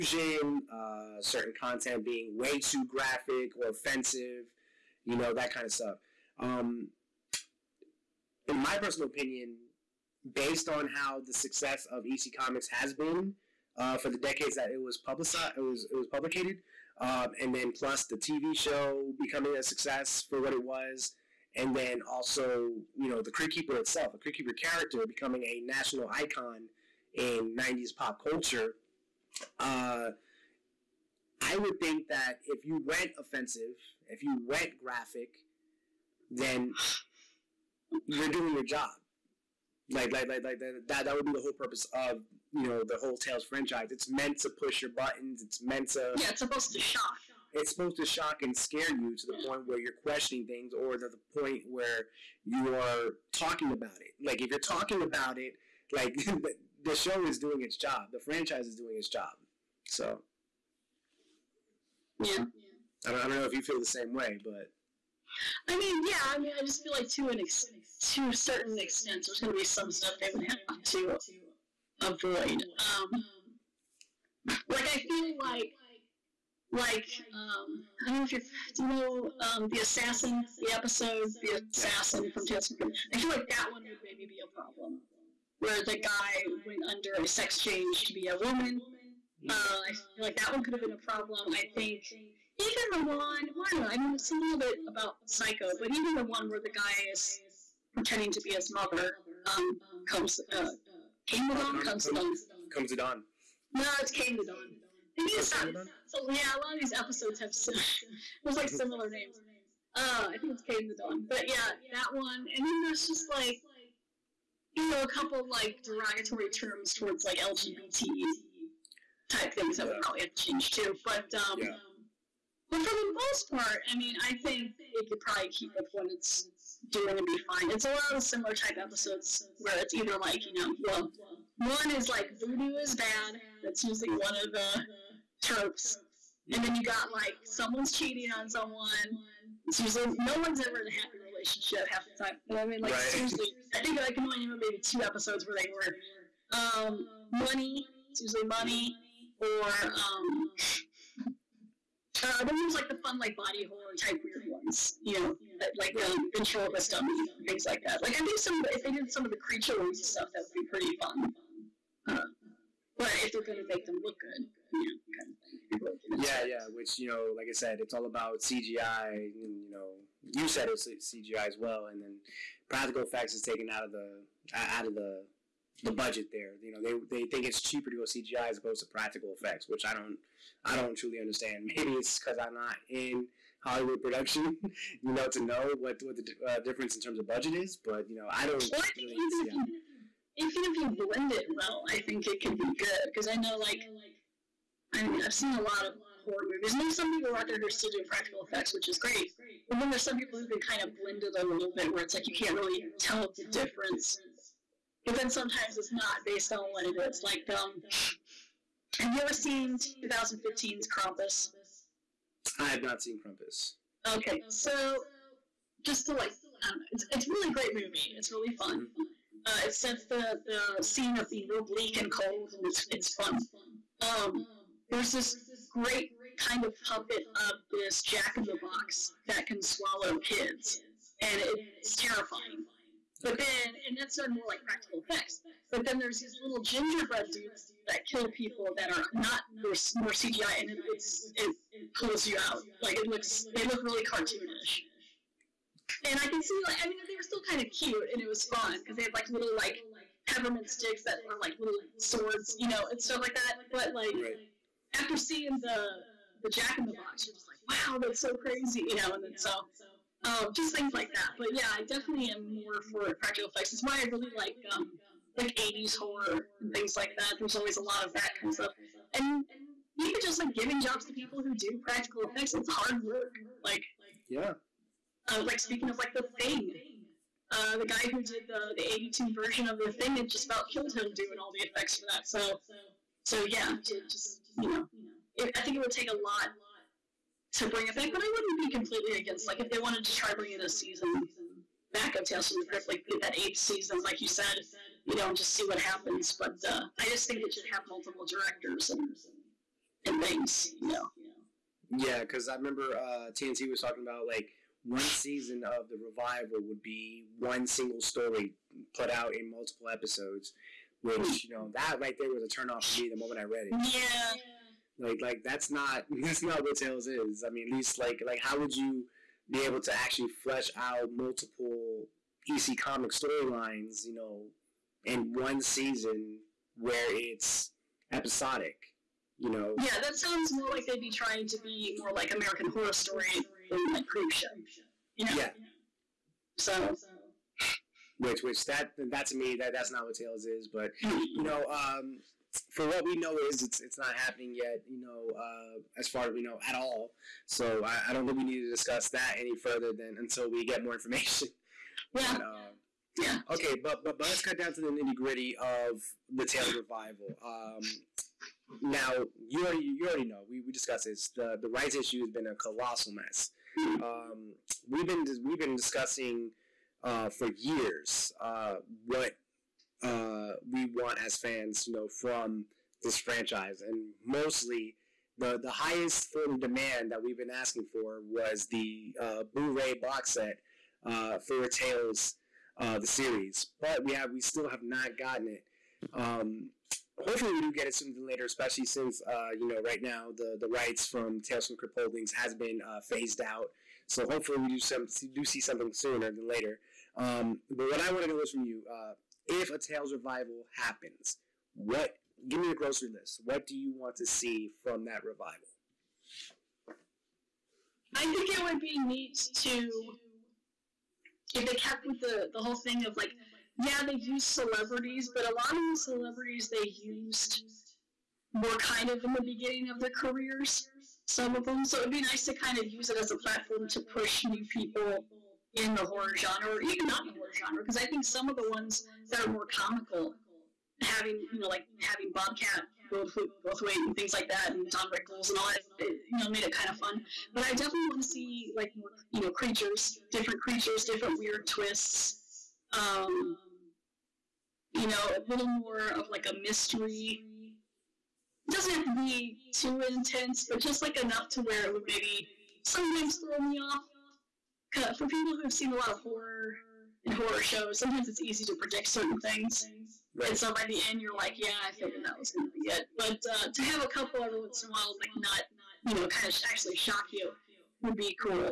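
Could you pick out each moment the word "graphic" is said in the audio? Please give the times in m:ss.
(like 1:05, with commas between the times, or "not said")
0:02, 0:34.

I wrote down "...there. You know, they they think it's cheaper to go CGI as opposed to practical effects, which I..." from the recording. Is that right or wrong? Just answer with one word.
right.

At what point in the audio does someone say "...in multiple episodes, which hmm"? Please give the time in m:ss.
5:09.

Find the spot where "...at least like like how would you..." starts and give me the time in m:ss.
5:17.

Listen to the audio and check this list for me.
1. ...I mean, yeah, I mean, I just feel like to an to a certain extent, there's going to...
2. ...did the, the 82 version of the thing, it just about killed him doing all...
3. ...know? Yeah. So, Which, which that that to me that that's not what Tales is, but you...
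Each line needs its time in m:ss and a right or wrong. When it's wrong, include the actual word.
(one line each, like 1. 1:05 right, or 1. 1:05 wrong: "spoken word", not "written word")
1. 1:05 right
2. 4:38 right
3. 5:35 right.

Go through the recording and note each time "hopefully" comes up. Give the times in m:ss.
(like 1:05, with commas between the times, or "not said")
6:27, 6:34.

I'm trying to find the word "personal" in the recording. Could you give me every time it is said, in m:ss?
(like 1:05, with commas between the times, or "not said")
0:08.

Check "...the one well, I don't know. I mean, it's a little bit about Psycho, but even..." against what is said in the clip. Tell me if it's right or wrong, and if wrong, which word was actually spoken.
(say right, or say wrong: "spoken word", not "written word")
right.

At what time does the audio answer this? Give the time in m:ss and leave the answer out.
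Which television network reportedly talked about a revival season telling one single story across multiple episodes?
5:03.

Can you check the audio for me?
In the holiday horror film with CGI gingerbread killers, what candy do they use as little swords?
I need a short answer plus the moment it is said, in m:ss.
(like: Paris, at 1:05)
peppermint sticks, at 4:10.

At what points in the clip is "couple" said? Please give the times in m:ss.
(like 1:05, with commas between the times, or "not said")
1:55, 7:44.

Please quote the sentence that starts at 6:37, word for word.
Um, but what I want to know is from you, uh, if a Tales revival happens, what give me a grocery list.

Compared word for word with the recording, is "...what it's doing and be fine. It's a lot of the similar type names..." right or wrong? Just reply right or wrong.
wrong.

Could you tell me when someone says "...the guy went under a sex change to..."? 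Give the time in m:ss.
1:25.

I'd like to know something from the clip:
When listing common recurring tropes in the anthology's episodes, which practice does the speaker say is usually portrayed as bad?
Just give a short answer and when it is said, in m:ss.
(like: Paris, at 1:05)
voodoo, at 2:12.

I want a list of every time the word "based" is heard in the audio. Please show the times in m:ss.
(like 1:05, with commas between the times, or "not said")
0:10, 3:26.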